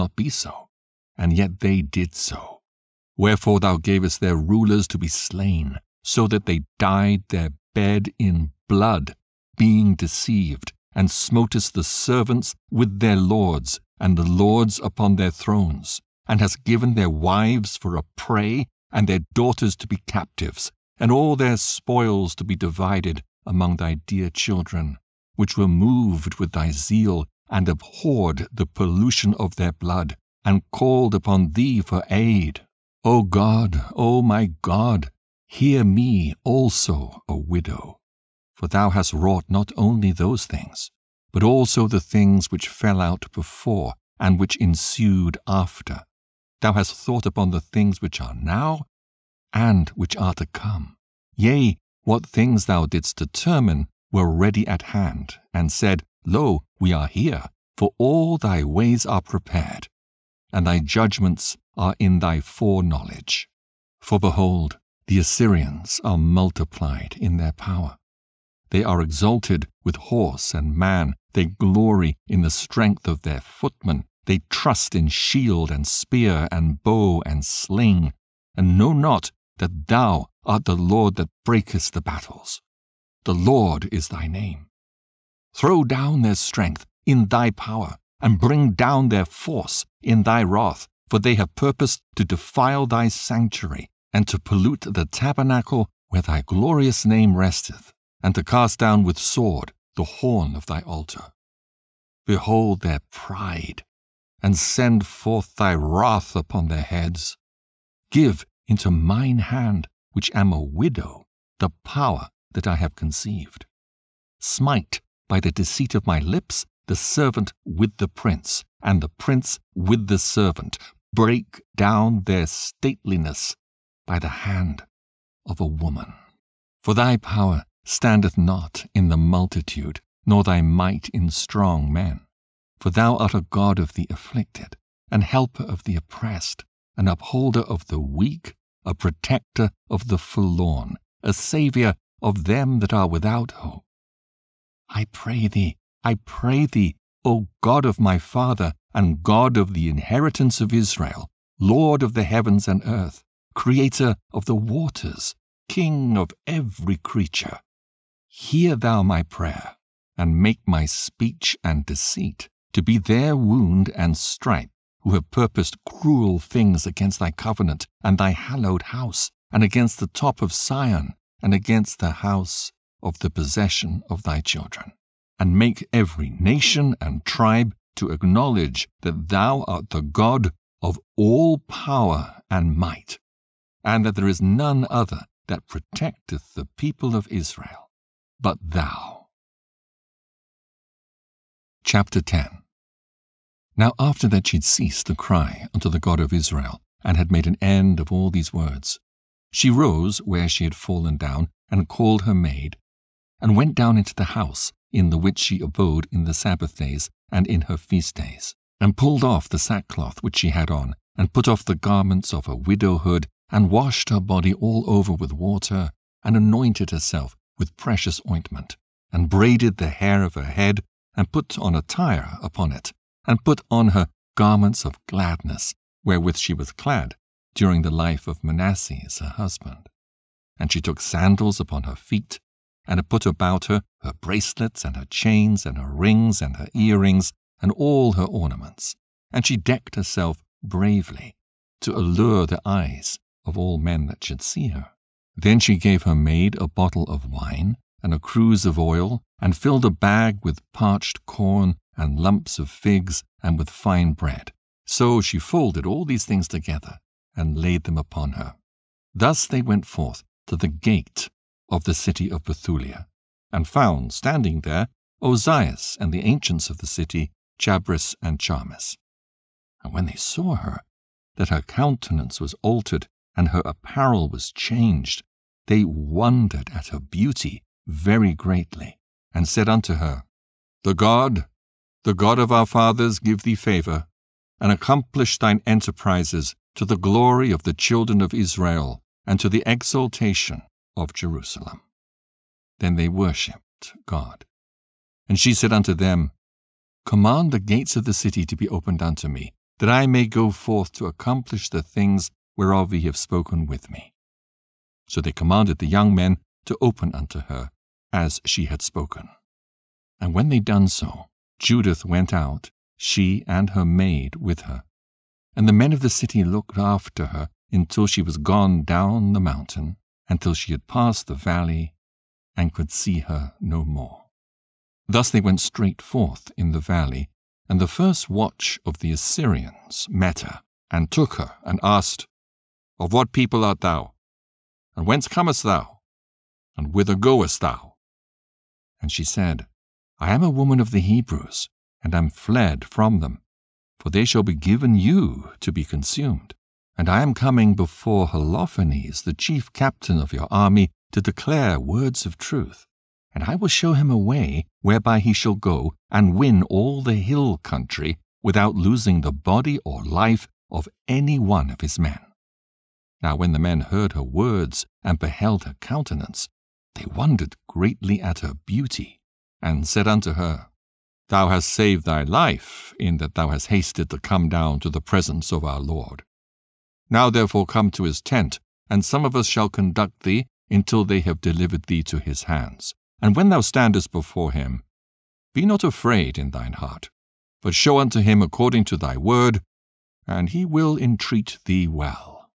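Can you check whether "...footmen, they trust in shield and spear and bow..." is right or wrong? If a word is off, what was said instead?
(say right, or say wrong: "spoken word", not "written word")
right.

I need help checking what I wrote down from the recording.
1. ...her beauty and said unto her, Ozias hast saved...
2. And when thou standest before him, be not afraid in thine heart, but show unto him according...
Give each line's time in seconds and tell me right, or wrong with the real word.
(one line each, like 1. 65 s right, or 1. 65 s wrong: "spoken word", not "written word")
1. 368 s wrong: "Thou", not "Ozias"
2. 383 s right.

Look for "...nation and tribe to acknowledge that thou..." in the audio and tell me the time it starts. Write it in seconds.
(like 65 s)
176 s.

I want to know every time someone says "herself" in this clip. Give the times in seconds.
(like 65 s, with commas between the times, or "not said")
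216 s, 239 s.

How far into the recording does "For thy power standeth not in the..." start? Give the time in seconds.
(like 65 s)
126 s.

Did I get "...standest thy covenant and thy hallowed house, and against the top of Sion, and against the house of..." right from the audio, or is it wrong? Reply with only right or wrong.
wrong.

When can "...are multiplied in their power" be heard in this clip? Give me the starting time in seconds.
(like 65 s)
66 s.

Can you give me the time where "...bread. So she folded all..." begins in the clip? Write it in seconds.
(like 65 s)
254 s.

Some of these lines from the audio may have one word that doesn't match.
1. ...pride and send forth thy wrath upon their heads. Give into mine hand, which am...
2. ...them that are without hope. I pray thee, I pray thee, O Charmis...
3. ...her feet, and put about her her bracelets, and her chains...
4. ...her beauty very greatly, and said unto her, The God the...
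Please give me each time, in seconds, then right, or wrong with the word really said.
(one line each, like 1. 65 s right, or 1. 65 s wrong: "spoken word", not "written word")
1. 103 s right
2. 142 s wrong: "God", not "Charmis"
3. 231 s right
4. 276 s right.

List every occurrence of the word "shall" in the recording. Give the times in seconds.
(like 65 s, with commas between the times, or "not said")
344 s, 355 s, 379 s.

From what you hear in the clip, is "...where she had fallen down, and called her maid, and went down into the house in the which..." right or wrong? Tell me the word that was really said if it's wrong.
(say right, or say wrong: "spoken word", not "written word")
right.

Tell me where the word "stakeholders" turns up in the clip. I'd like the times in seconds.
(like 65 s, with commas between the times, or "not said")
not said.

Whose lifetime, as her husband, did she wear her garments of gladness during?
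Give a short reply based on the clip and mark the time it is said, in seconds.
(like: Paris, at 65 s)
Manasseh, at 228 s.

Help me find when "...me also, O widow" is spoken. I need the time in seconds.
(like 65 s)
35 s.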